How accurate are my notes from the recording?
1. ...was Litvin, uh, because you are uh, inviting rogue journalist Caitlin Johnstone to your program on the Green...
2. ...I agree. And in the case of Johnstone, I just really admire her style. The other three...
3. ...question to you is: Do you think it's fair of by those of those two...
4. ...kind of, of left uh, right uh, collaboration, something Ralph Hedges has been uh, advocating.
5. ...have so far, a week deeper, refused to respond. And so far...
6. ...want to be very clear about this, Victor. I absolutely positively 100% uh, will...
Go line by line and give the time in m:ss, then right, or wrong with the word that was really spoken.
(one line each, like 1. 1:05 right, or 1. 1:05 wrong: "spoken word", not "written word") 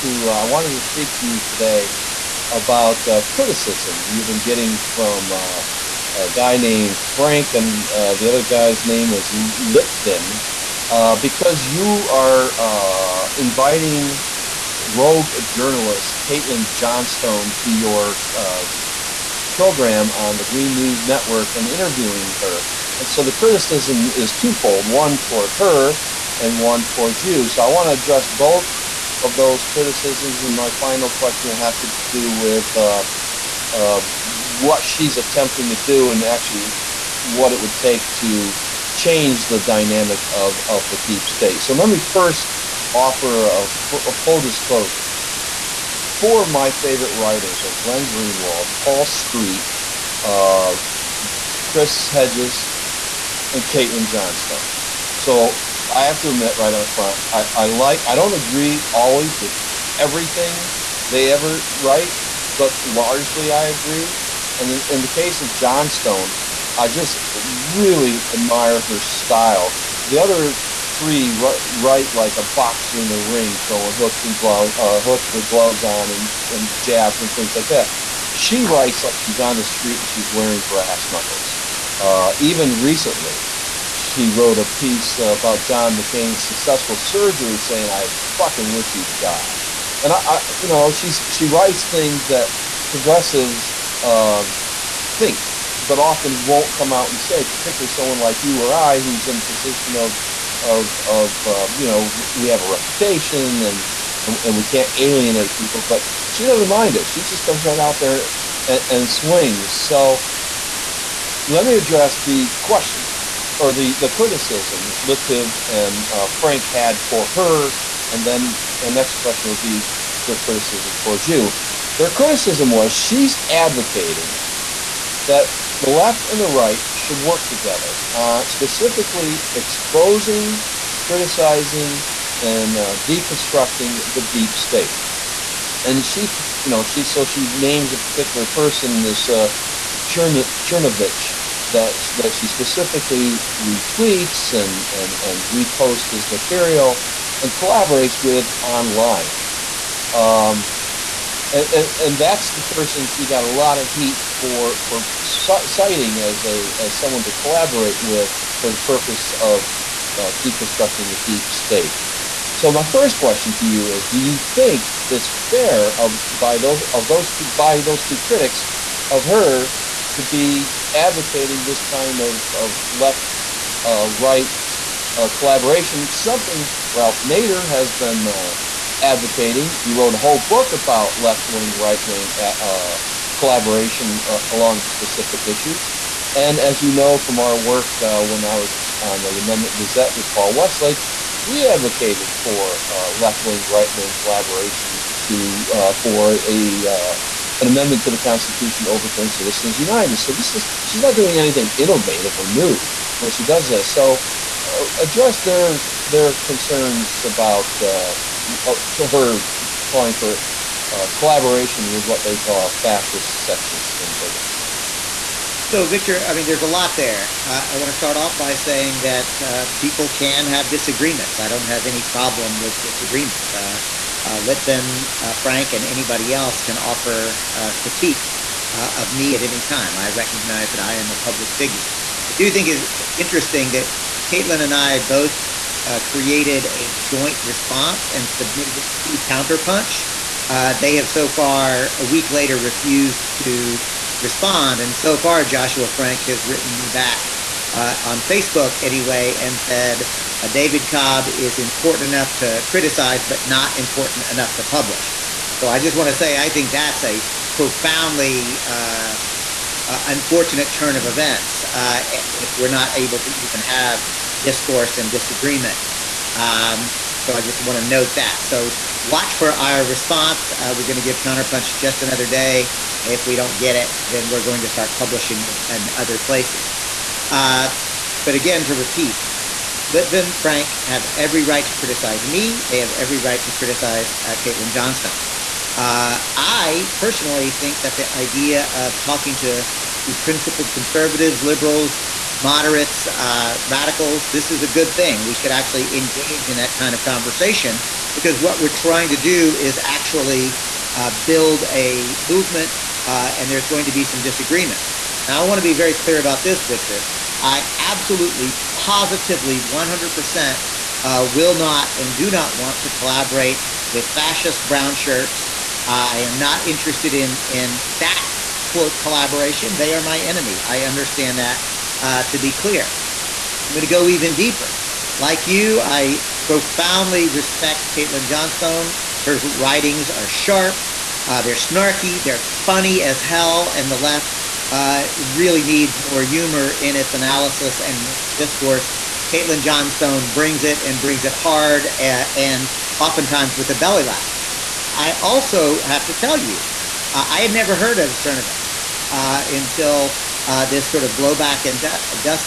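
1. 0:09 right
2. 1:03 right
3. 2:43 right
4. 2:51 wrong: "Nader", not "Hedges"
5. 4:00 wrong: "later", not "deeper"
6. 5:05 right.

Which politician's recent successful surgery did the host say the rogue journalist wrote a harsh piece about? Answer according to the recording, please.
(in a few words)
John McCain.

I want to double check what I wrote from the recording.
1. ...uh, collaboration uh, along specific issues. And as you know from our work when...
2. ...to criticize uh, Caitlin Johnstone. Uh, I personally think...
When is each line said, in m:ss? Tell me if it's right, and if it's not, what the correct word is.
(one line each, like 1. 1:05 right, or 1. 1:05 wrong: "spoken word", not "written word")
1. 3:02 right
2. 4:43 right.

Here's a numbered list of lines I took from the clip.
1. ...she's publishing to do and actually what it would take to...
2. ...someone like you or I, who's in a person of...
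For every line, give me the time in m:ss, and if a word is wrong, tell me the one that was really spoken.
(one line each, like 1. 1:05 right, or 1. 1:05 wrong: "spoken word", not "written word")
1. 0:34 wrong: "attempting", not "publishing"
2. 1:37 wrong: "position", not "person".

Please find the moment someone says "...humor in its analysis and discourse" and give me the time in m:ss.
5:36.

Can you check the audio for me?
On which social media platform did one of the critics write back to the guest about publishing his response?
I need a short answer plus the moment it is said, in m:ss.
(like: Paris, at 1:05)
Facebook, at 4:08.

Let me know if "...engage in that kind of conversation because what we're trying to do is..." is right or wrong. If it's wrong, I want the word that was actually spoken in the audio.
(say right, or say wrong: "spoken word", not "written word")
right.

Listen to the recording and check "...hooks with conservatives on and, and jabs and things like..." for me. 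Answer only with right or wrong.
wrong.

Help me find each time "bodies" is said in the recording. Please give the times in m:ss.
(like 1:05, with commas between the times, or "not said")
not said.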